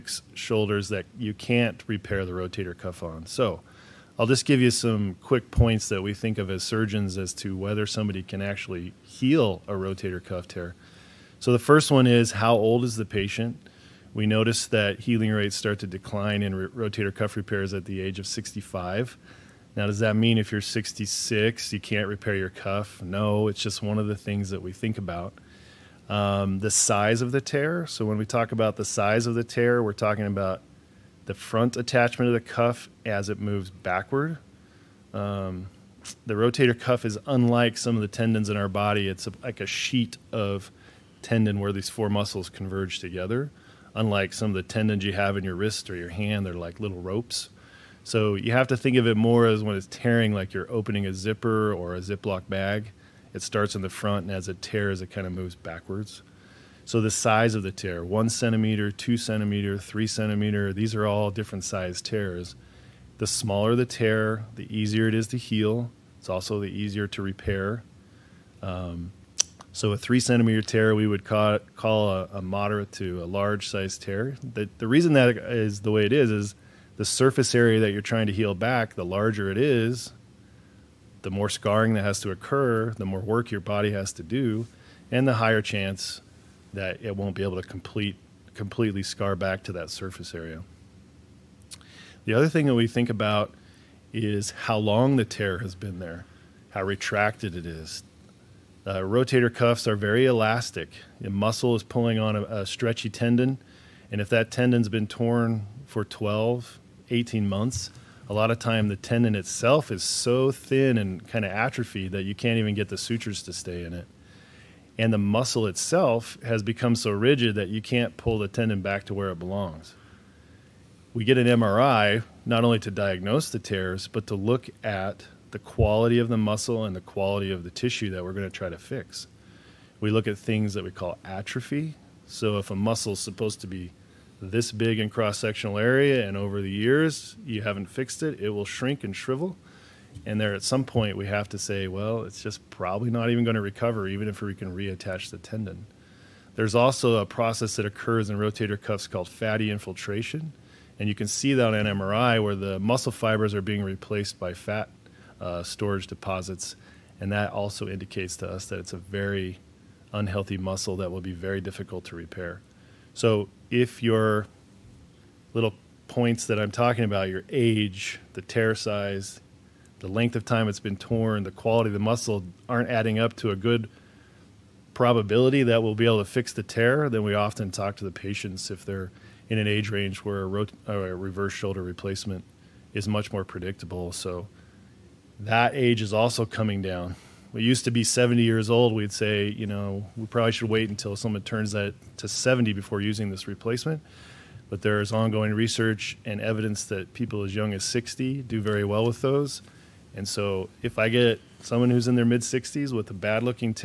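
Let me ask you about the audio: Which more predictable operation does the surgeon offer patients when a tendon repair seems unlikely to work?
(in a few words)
Reverse shoulder replacement.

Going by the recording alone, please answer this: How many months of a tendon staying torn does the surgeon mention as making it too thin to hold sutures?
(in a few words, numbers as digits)
12 to 18 months.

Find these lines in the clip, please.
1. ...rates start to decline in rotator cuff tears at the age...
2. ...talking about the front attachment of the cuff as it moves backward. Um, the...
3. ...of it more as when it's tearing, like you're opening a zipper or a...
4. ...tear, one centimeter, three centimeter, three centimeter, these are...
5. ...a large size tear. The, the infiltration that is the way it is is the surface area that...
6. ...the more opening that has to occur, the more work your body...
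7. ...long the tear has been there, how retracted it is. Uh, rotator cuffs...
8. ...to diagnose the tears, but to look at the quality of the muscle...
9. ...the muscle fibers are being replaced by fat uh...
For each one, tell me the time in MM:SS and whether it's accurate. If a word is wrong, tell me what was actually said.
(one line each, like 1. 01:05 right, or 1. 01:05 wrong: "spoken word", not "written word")
1. 00:15 wrong: "repairs", not "tears"
2. 00:29 right
3. 00:48 right
4. 00:57 wrong: "two", not "three"
5. 01:13 wrong: "reason", not "infiltration"
6. 01:21 wrong: "scarring", not "opening"
7. 01:34 right
8. 02:02 right
9. 02:32 right.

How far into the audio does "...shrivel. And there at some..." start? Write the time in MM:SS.
02:19.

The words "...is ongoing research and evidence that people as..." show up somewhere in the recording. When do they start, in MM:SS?
03:15.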